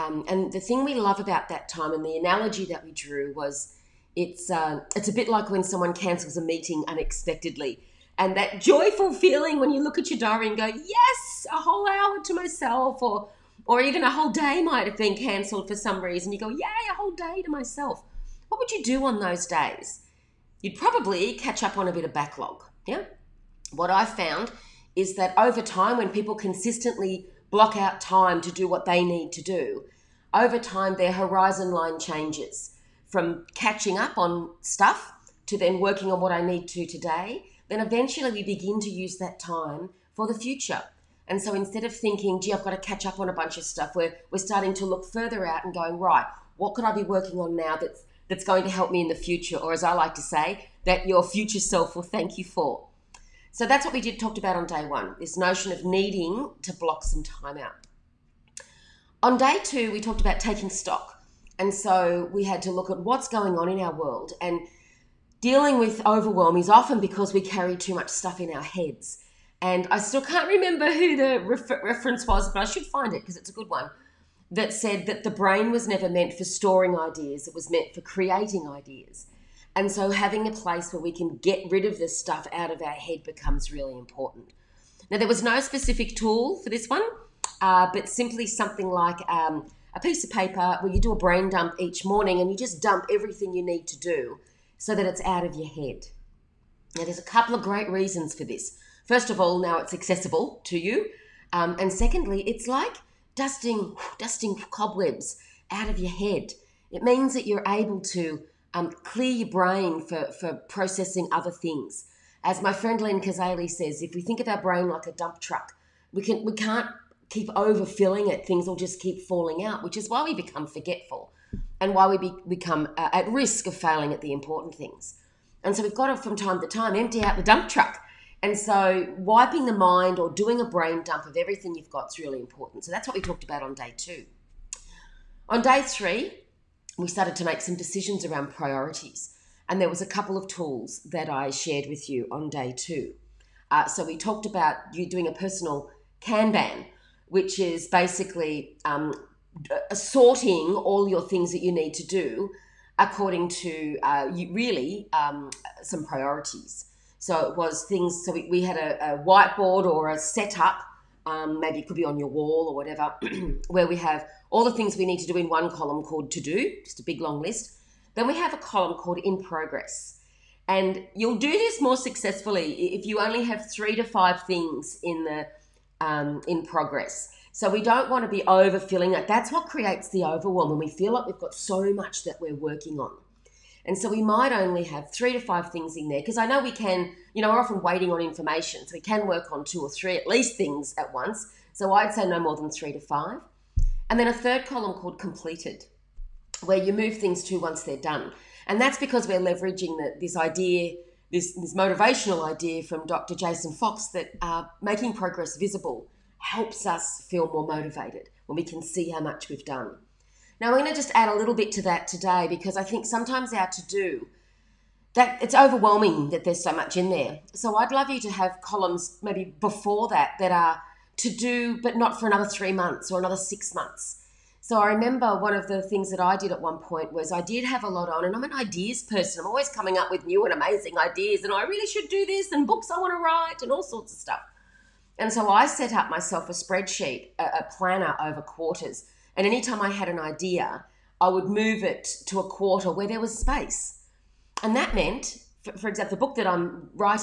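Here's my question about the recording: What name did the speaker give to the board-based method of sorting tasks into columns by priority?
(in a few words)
personal Kanban.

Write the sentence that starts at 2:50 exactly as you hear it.
And you'll do this more successfully if you only have three to five things in the um, in progress.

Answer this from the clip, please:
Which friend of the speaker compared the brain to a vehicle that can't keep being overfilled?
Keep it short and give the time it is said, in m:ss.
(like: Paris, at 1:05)
Len Kazaley, at 1:52.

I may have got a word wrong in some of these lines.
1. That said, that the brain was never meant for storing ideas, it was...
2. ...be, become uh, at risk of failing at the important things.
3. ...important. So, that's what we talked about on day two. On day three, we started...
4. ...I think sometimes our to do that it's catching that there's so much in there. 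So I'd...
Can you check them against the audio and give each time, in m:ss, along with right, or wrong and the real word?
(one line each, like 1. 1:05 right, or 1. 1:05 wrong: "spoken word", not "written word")
1. 1:14 right
2. 2:02 right
3. 2:12 right
4. 3:32 wrong: "overwhelming", not "catching".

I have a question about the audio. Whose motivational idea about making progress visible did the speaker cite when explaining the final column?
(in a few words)
Dr. Jason Fox.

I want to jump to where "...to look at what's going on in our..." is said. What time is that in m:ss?
1:02.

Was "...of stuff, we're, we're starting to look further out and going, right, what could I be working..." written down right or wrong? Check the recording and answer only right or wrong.
right.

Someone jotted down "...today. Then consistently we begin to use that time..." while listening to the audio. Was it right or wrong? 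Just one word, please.
wrong.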